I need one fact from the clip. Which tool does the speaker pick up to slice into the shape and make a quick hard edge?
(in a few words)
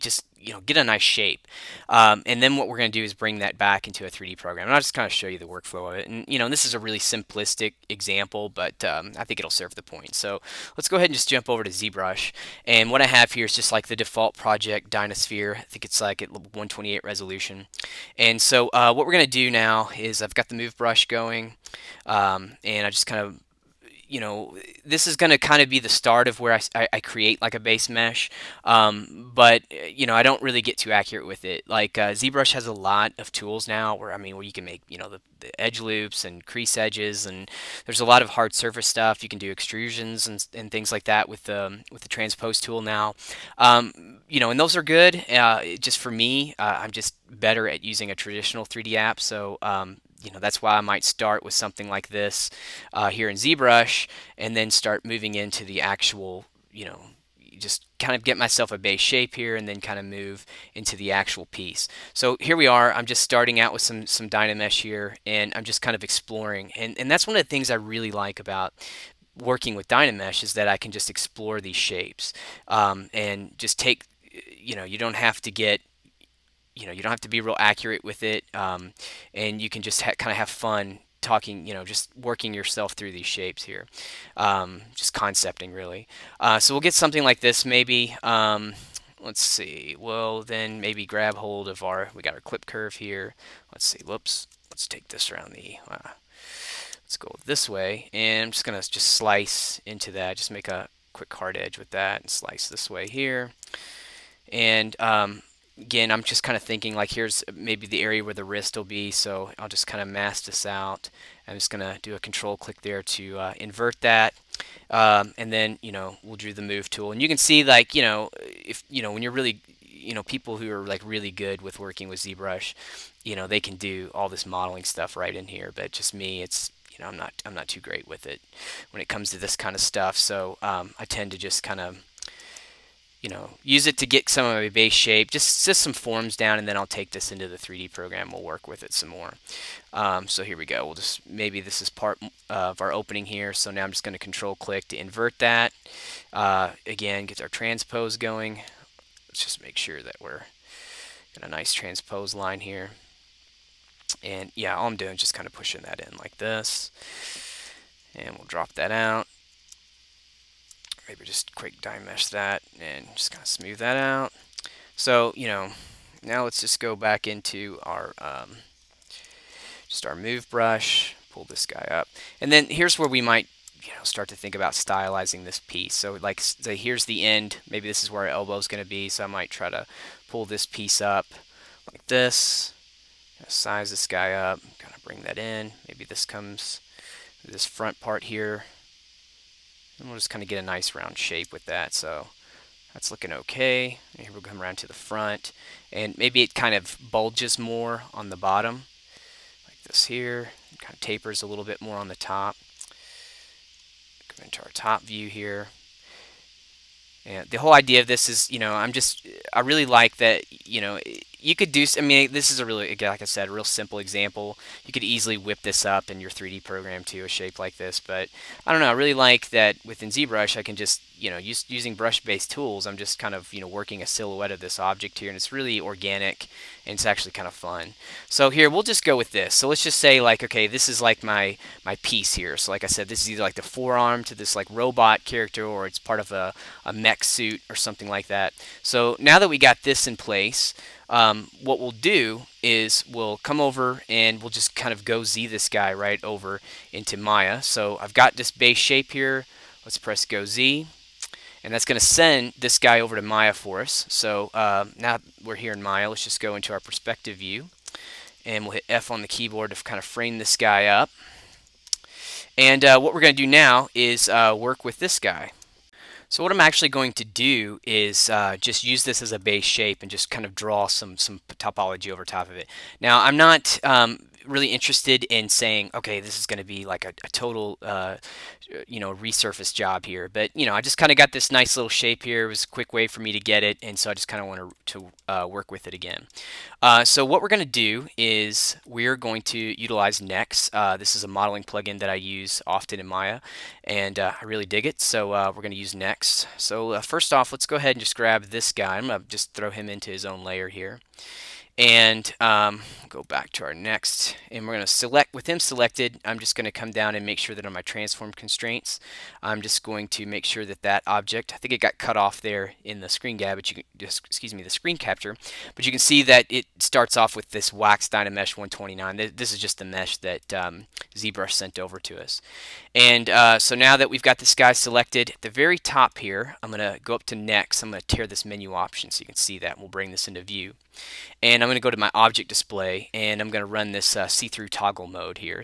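clip curve.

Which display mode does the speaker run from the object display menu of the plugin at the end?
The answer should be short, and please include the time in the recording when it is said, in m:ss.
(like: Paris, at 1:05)
see-through toggle mode, at 5:34.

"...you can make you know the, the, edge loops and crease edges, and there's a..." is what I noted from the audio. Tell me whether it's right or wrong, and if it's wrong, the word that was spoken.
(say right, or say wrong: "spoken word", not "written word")
right.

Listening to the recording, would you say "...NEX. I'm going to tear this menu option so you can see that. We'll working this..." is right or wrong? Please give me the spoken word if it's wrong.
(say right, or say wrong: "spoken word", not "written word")
wrong: "bring", not "working".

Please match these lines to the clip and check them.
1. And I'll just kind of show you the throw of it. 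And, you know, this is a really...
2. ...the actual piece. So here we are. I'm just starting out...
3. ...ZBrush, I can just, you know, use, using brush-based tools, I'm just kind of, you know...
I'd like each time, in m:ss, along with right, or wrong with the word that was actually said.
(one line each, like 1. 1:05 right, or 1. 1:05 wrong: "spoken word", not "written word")
1. 0:04 wrong: "workflow", not "throw"
2. 1:00 right
3. 3:40 right.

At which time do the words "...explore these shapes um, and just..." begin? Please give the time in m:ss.
1:11.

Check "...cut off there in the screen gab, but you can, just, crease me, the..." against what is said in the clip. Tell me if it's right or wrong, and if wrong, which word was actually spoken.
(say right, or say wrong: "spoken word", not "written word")
wrong: "excuse", not "crease".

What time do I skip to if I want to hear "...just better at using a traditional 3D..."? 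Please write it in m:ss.
0:46.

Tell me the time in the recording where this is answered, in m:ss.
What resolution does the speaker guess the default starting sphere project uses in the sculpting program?
0:16.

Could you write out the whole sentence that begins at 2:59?
So I might try to pull this piece up like this, size this guy up, kind of bring that in.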